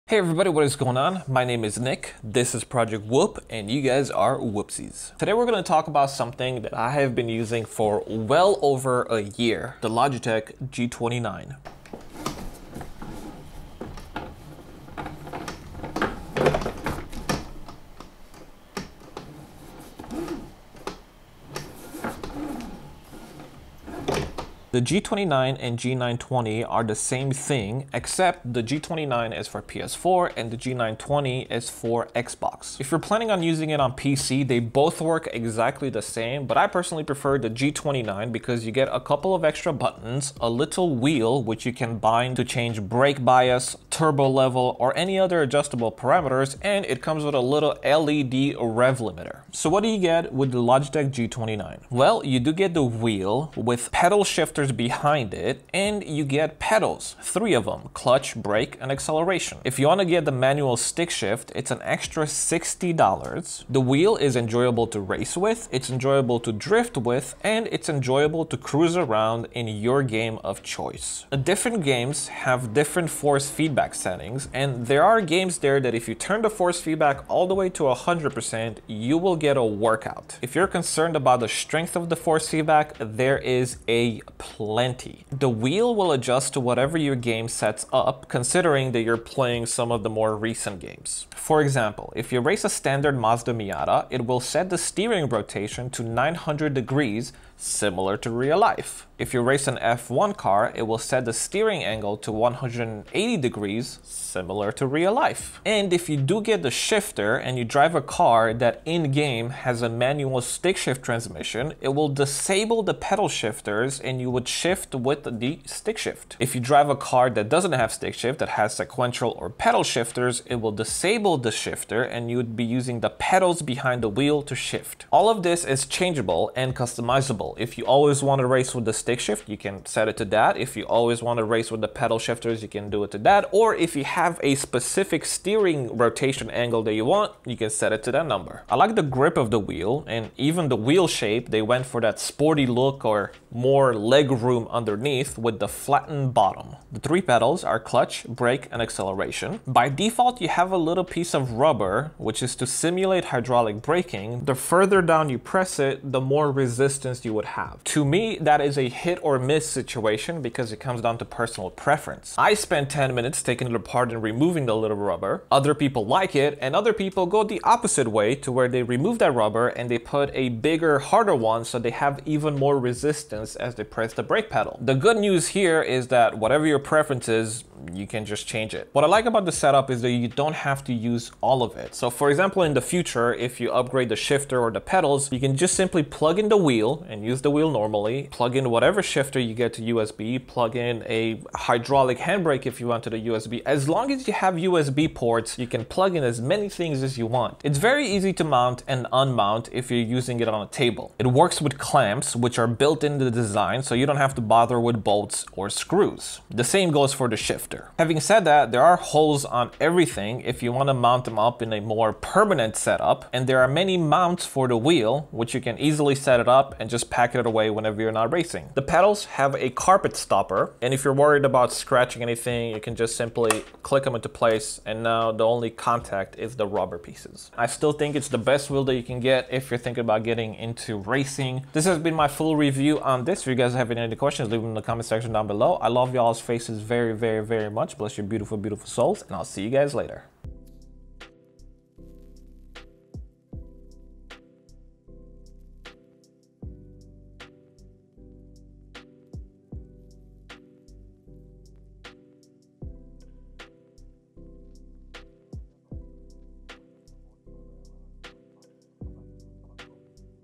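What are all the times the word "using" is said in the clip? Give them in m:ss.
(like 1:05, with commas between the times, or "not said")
0:07, 0:33, 2:02, 3:19.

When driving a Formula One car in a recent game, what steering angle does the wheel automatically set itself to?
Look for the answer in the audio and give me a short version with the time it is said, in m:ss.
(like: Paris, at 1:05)
180 degrees, at 1:42.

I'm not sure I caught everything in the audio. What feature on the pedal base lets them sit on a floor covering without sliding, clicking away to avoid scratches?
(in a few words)
carpet stopper.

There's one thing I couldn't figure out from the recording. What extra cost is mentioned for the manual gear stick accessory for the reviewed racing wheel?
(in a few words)
$60.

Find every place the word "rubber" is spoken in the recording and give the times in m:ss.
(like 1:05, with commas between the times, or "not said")
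2:31, 2:44, 2:49, 3:46.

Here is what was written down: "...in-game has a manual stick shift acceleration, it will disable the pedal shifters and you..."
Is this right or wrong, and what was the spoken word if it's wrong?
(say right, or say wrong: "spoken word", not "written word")
wrong: "transmission", not "acceleration".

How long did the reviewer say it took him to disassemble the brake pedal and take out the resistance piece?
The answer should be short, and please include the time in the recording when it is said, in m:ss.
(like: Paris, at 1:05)
10 minutes, at 2:42.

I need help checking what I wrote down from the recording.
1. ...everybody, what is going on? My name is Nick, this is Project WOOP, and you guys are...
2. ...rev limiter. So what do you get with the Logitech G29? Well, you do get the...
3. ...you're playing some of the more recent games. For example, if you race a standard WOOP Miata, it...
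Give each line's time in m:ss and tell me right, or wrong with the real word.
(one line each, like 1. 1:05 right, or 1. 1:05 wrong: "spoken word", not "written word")
1. 0:00 right
2. 0:48 right
3. 1:29 wrong: "Mazda", not "WOOP".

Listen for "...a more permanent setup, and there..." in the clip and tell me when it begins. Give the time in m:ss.
3:31.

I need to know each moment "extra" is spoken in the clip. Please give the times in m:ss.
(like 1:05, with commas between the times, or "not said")
0:39, 1:01.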